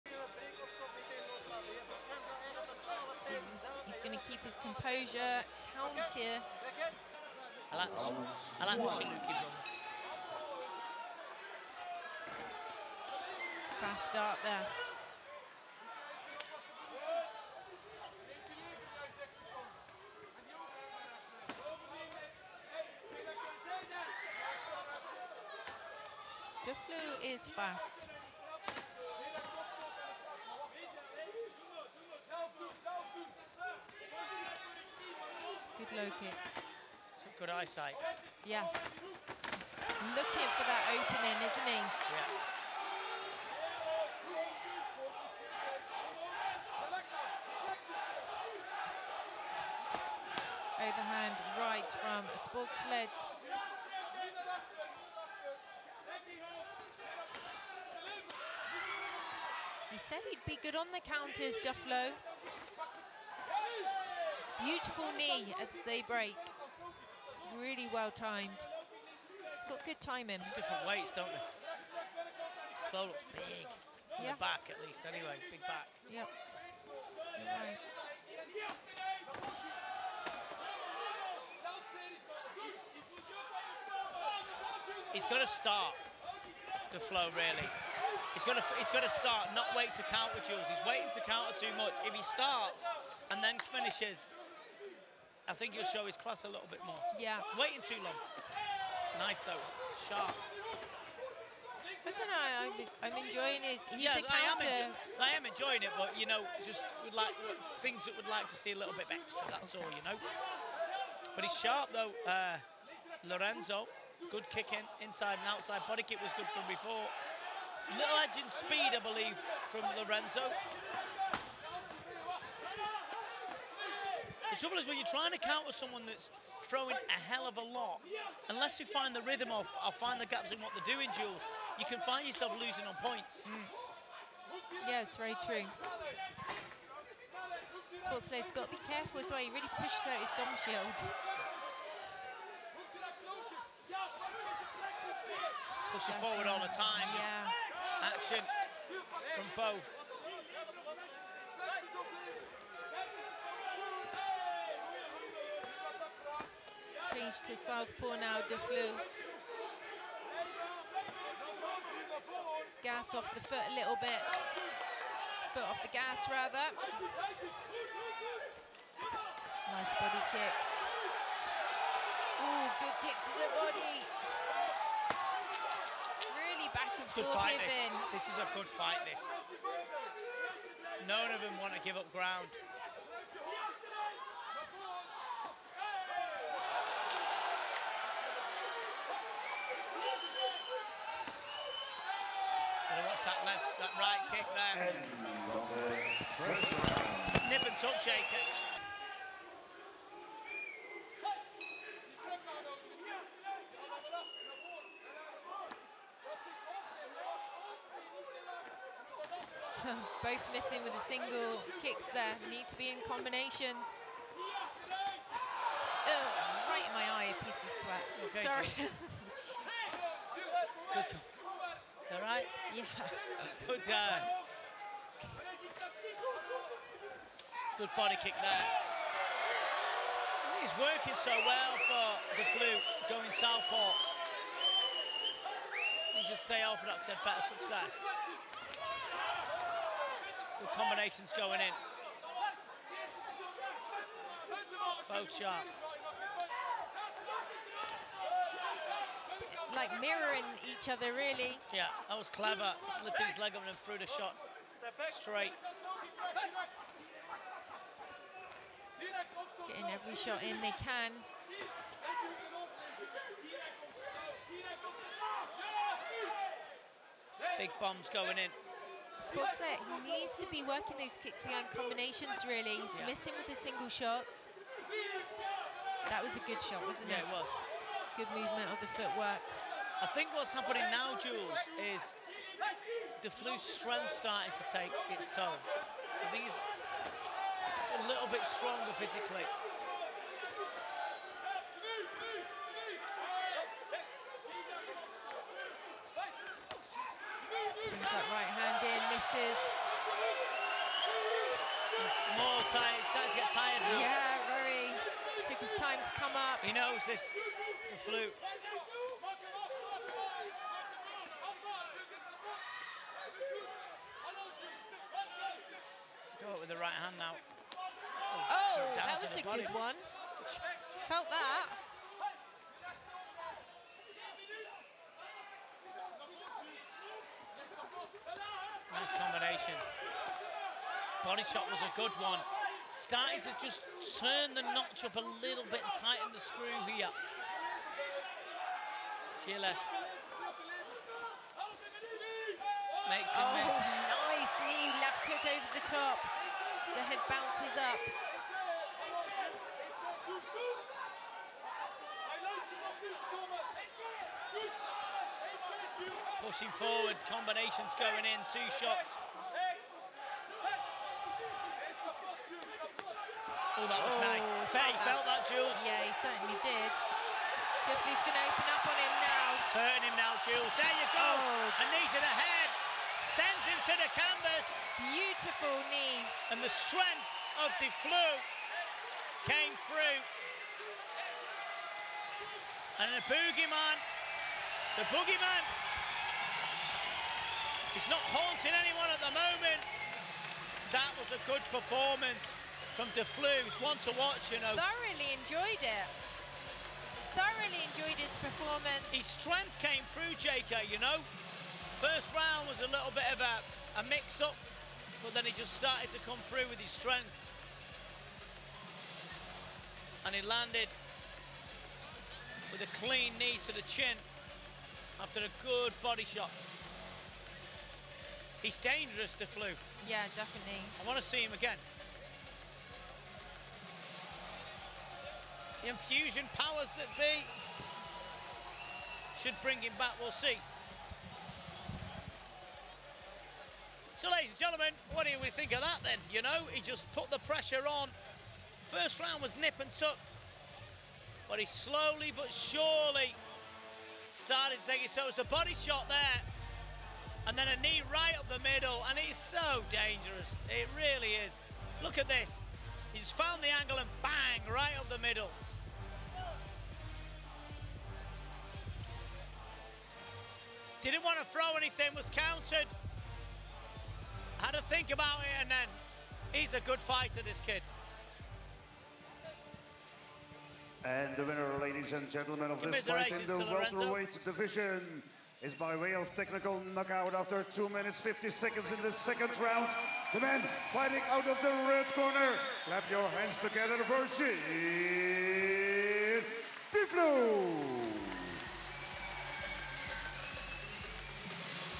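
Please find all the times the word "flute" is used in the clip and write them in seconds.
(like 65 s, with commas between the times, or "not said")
307 s.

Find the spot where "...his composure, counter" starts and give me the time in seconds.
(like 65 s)
4 s.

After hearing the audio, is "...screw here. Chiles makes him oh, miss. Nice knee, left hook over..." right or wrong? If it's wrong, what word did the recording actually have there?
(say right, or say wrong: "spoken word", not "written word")
right.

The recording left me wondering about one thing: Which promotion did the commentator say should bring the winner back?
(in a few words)
Enfusion.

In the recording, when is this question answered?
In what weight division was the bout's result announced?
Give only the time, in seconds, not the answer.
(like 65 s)
473 s.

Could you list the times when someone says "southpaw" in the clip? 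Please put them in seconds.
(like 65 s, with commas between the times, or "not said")
157 s, 233 s.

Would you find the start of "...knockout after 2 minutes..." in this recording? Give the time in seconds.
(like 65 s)
476 s.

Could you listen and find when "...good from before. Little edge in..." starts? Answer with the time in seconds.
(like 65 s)
116 s.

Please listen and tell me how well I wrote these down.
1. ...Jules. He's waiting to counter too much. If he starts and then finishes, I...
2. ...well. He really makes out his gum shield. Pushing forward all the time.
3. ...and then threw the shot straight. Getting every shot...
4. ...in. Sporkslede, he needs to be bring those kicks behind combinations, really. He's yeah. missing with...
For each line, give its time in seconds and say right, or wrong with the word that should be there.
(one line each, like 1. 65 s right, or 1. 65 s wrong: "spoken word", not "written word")
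1. 90 s right
2. 139 s wrong: "pushes", not "makes"
3. 253 s right
4. 268 s wrong: "working", not "bring".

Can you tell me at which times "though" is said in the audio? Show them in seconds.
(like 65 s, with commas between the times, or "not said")
99 s, 111 s.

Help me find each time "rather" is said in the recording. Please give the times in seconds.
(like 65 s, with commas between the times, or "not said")
166 s.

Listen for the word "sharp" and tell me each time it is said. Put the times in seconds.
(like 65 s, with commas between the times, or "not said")
100 s, 111 s, 245 s.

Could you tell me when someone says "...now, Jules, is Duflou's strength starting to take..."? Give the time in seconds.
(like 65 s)
280 s.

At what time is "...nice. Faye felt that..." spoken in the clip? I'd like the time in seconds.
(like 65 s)
364 s.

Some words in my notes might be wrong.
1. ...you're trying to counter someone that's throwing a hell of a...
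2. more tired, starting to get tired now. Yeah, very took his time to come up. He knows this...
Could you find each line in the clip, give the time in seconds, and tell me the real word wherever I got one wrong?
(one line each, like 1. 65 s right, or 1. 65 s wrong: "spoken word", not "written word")
1. 124 s right
2. 302 s right.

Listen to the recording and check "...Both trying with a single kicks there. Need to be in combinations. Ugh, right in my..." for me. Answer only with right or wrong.
wrong.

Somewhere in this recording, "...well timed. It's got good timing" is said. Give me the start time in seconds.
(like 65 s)
67 s.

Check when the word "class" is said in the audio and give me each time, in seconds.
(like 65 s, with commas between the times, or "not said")
96 s.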